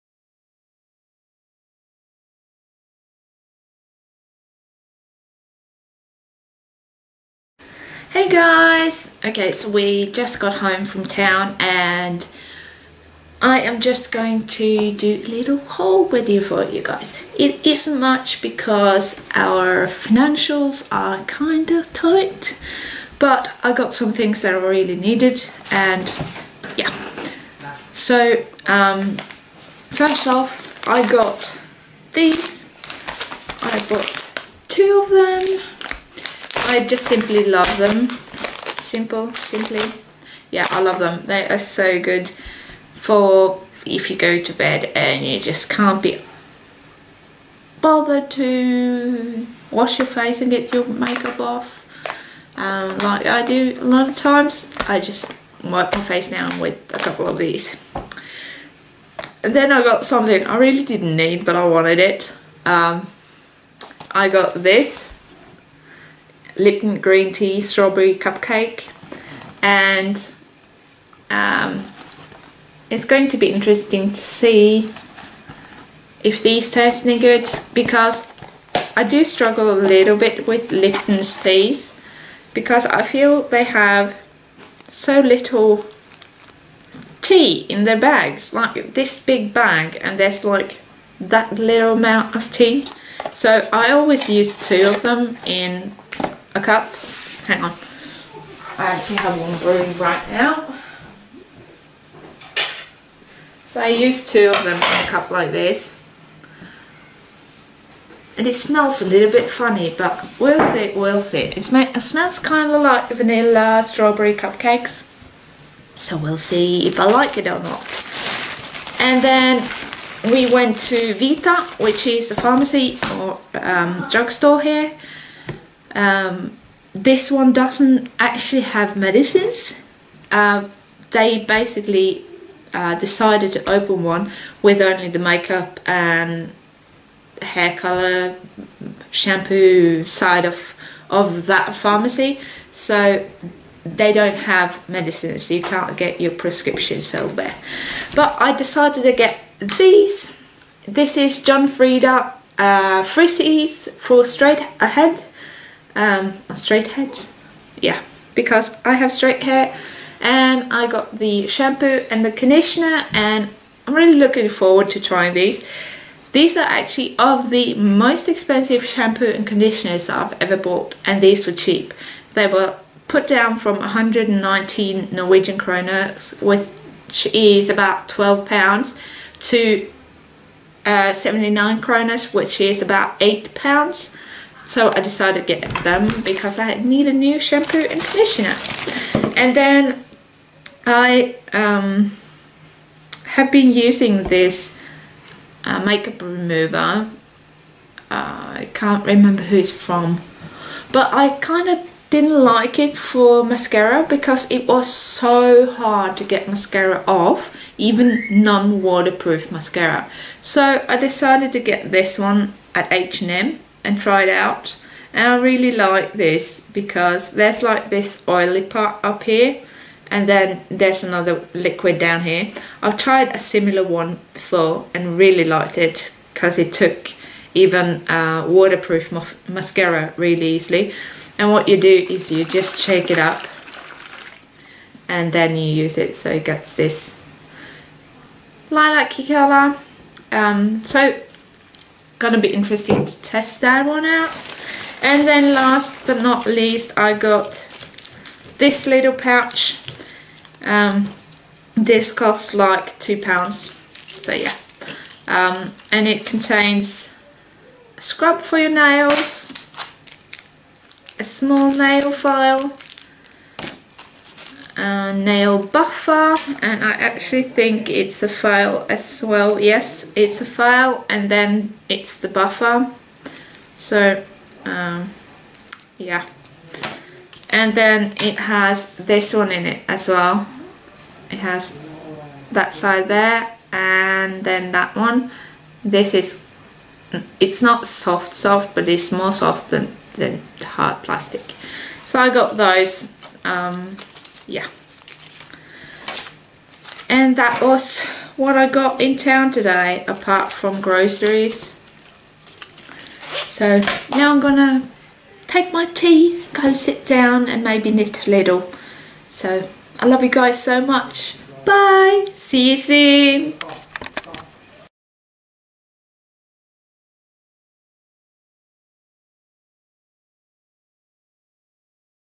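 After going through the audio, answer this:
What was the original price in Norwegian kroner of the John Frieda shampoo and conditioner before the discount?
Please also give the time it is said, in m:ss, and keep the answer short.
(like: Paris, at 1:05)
119, at 2:53.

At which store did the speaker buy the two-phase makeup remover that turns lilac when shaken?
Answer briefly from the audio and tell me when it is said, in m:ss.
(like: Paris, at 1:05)
H&M, at 3:32.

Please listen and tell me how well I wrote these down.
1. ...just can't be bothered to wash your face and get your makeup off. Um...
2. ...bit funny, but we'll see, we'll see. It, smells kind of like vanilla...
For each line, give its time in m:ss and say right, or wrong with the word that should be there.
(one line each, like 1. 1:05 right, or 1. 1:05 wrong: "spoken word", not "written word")
1. 0:45 right
2. 1:49 right.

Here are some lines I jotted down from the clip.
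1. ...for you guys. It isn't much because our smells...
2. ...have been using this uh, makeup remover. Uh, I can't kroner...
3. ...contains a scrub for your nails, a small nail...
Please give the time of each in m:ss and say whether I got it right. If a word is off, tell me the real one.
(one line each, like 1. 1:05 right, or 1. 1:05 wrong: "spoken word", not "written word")
1. 0:16 wrong: "financials", not "smells"
2. 3:13 wrong: "remember", not "kroner"
3. 4:16 right.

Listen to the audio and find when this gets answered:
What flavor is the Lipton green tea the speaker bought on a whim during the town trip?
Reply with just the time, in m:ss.
1:07.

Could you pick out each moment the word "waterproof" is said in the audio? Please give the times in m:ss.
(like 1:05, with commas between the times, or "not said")
3:28, 3:48.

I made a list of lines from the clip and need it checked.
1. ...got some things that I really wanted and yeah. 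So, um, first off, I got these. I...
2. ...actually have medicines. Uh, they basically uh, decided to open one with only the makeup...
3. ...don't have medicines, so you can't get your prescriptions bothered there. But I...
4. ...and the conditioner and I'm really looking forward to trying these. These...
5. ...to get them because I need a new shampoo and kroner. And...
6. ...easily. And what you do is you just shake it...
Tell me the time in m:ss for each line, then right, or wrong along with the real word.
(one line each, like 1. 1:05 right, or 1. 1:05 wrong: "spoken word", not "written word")
1. 0:23 wrong: "needed", not "wanted"
2. 2:08 right
3. 2:24 wrong: "filled", not "bothered"
4. 2:42 right
5. 3:05 wrong: "conditioner", not "kroner"
6. 3:50 right.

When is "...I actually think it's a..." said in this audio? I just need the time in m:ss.
4:26.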